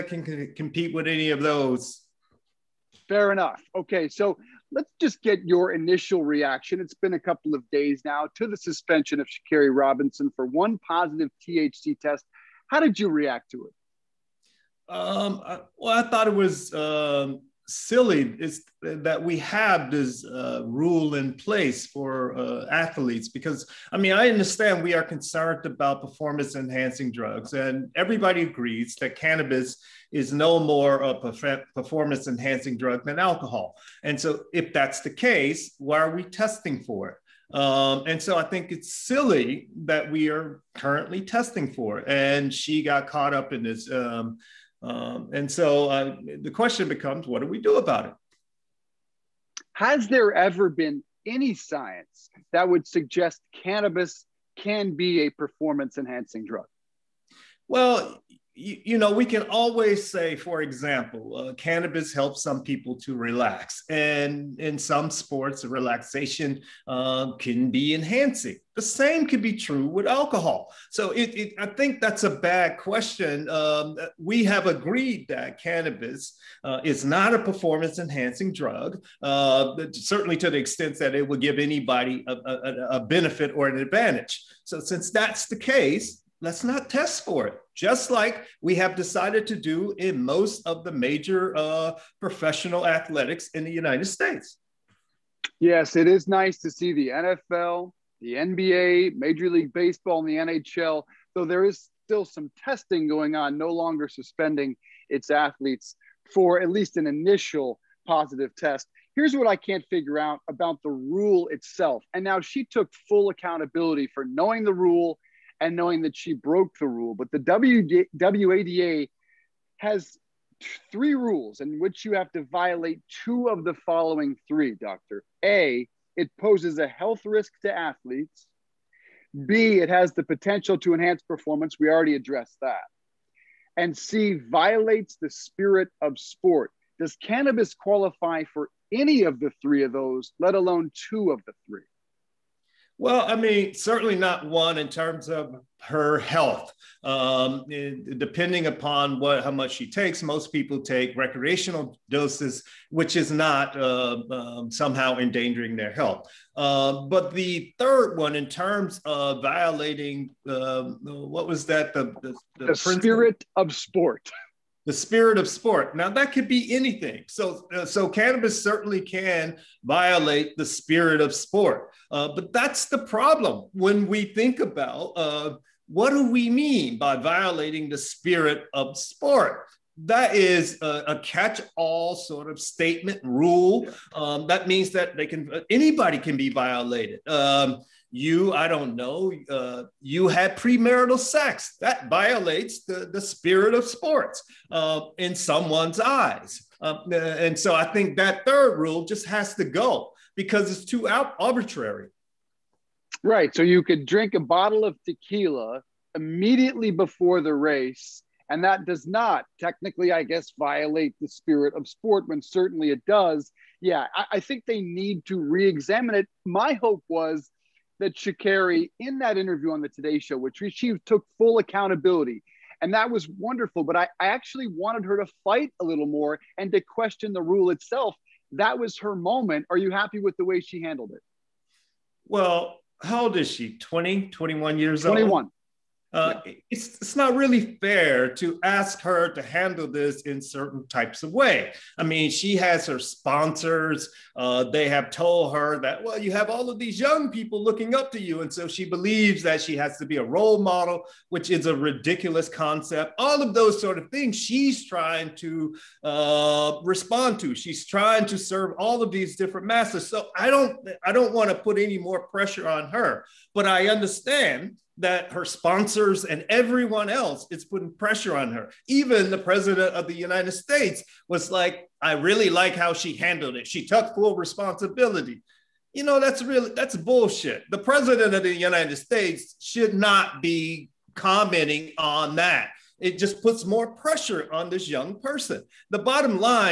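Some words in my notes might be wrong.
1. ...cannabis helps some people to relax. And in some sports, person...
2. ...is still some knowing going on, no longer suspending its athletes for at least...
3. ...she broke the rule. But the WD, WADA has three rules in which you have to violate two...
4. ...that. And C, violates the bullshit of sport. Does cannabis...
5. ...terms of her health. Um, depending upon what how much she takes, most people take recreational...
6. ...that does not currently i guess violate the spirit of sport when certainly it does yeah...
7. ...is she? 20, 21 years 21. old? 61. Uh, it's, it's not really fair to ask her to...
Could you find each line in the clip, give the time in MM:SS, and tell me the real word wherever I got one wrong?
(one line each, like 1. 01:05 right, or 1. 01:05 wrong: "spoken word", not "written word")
1. 01:01 wrong: "relaxation", not "person"
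2. 01:41 wrong: "testing", not "knowing"
3. 01:56 right
4. 02:12 wrong: "spirit", not "bullshit"
5. 02:24 right
6. 03:28 wrong: "technically", not "currently"
7. 03:53 wrong: "21", not "61".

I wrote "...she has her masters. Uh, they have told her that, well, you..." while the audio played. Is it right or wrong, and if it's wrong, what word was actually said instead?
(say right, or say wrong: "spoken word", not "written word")
wrong: "sponsors", not "masters".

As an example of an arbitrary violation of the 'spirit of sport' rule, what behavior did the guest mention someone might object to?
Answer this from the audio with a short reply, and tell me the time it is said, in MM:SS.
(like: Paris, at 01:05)
Premarital sex, at 03:10.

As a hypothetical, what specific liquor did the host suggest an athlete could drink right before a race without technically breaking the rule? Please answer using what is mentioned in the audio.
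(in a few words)
Tequila.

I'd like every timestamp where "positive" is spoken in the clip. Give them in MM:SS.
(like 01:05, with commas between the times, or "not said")
00:10, 01:48.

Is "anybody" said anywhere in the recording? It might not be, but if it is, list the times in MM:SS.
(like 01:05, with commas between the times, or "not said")
01:21, 03:05.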